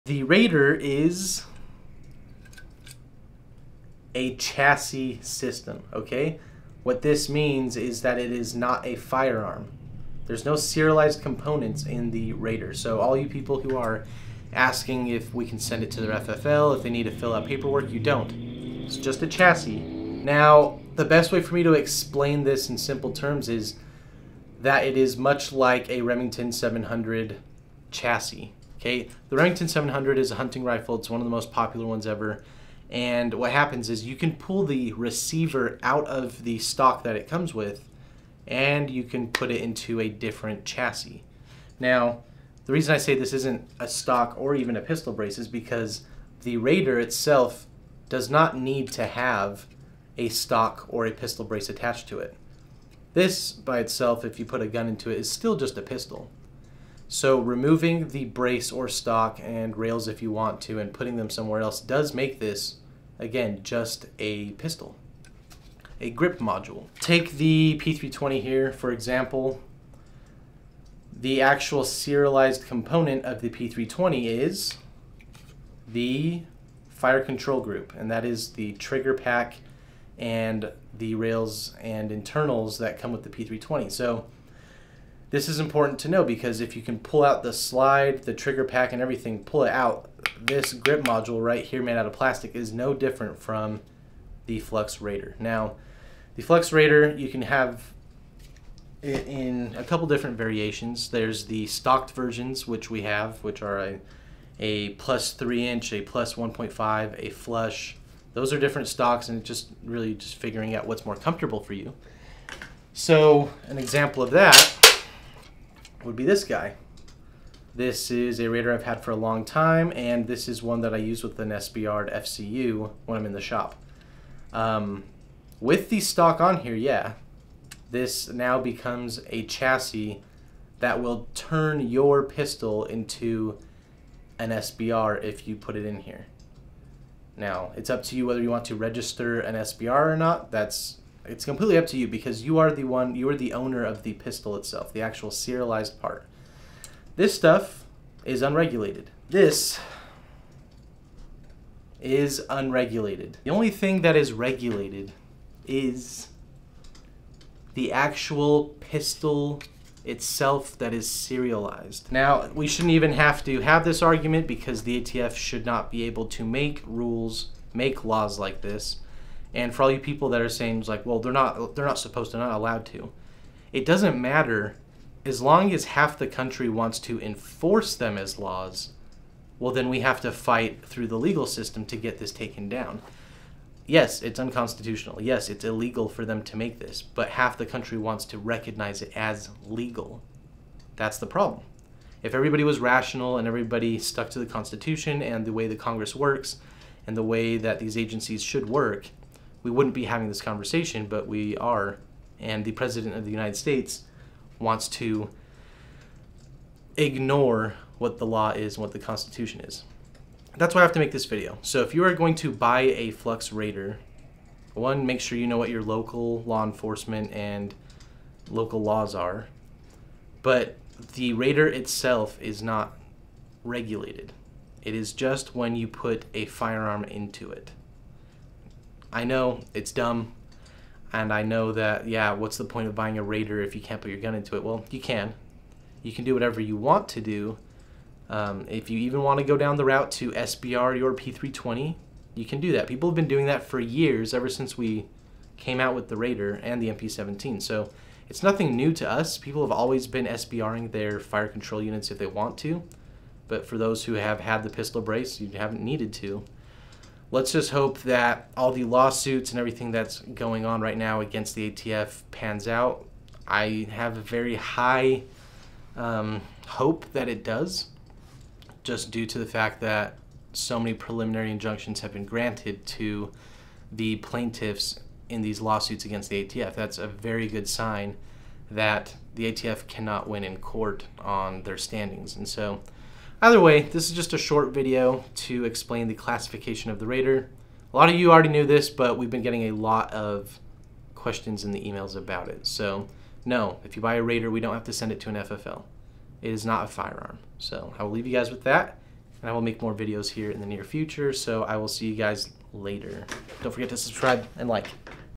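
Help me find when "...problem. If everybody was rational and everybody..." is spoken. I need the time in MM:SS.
03:11.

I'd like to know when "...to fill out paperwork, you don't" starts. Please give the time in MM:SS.
00:17.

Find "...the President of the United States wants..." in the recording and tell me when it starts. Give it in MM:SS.
03:22.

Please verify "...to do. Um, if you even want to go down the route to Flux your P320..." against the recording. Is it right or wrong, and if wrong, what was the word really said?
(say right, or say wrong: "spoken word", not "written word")
wrong: "SBR", not "Flux".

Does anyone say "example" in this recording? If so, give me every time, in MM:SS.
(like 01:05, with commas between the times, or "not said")
01:08, 01:53.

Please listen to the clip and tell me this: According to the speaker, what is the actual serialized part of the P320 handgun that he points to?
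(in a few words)
fire control group.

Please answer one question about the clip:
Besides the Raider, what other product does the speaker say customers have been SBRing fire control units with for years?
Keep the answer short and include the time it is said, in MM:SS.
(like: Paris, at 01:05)
MP17, at 04:06.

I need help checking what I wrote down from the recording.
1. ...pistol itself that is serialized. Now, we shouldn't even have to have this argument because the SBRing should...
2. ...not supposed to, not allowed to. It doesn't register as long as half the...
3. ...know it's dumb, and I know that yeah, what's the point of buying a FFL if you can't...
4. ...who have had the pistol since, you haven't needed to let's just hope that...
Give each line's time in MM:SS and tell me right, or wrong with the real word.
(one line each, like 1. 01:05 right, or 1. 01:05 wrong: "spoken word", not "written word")
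1. 02:38 wrong: "ATF", not "SBRing"
2. 02:51 wrong: "matter", not "register"
3. 03:49 wrong: "Raider", not "FFL"
4. 04:14 wrong: "brace", not "since".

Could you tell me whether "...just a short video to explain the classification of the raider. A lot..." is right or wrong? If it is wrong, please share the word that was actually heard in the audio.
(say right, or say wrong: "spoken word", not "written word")
right.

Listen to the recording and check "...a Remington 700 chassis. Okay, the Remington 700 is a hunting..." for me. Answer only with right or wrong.
right.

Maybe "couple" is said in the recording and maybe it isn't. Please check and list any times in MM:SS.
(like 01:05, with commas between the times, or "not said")
01:39.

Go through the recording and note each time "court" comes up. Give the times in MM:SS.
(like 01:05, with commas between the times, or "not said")
04:40.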